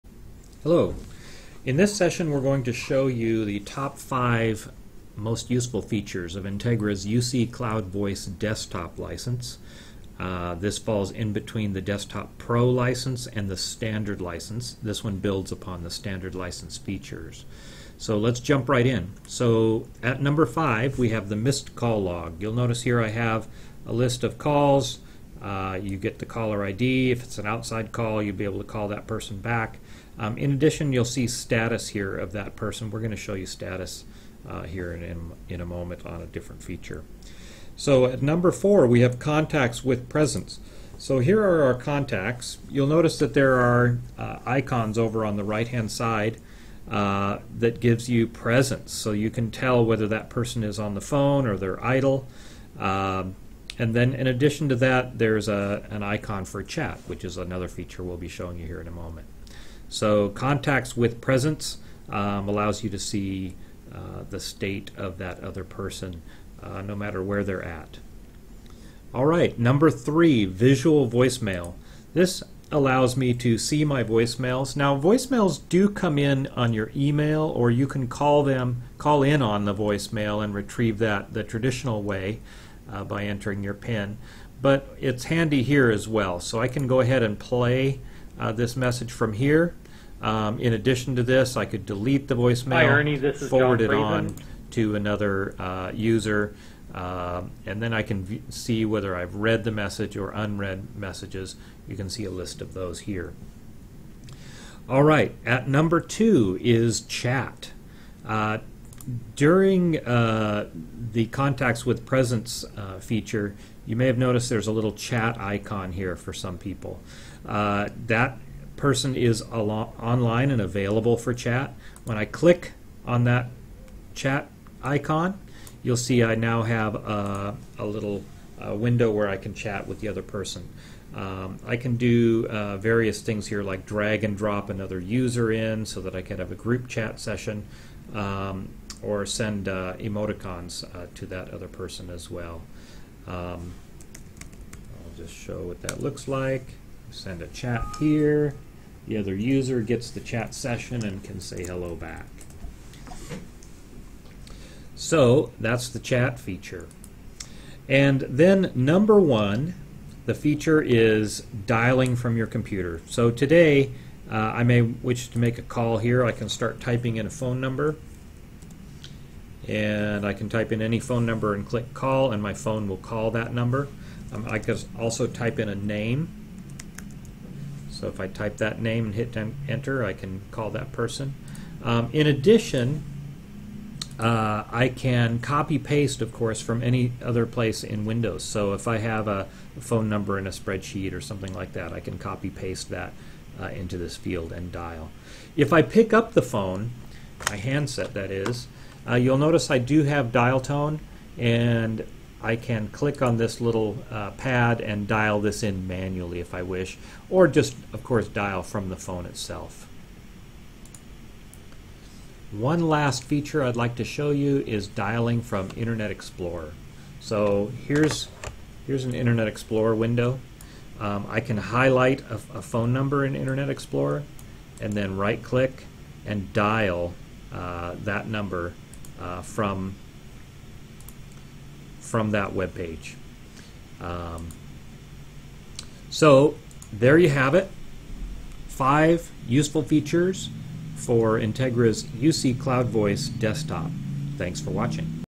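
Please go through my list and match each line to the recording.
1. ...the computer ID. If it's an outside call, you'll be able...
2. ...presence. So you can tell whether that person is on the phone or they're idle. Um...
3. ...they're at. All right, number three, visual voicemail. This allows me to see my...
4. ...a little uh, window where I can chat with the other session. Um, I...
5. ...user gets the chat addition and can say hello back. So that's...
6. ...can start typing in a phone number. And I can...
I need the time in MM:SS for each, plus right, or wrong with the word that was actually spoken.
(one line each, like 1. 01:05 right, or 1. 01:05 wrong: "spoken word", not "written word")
1. 00:26 wrong: "caller", not "computer"
2. 00:48 right
3. 01:07 right
4. 02:07 wrong: "person", not "session"
5. 02:29 wrong: "session", not "addition"
6. 02:46 right.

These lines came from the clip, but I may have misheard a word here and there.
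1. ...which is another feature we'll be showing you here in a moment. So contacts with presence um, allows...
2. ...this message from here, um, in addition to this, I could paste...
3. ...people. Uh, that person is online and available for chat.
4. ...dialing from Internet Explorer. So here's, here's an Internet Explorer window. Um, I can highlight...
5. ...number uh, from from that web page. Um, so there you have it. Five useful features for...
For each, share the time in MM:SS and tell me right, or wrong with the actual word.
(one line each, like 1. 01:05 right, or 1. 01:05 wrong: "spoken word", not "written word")
1. 00:57 right
2. 01:28 wrong: "delete", not "paste"
3. 01:56 right
4. 03:34 right
5. 03:48 right.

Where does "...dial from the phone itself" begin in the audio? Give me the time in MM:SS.
03:28.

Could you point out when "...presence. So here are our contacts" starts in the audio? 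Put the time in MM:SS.
00:40.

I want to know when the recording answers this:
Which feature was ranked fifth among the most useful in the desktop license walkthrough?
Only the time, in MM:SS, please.
00:21.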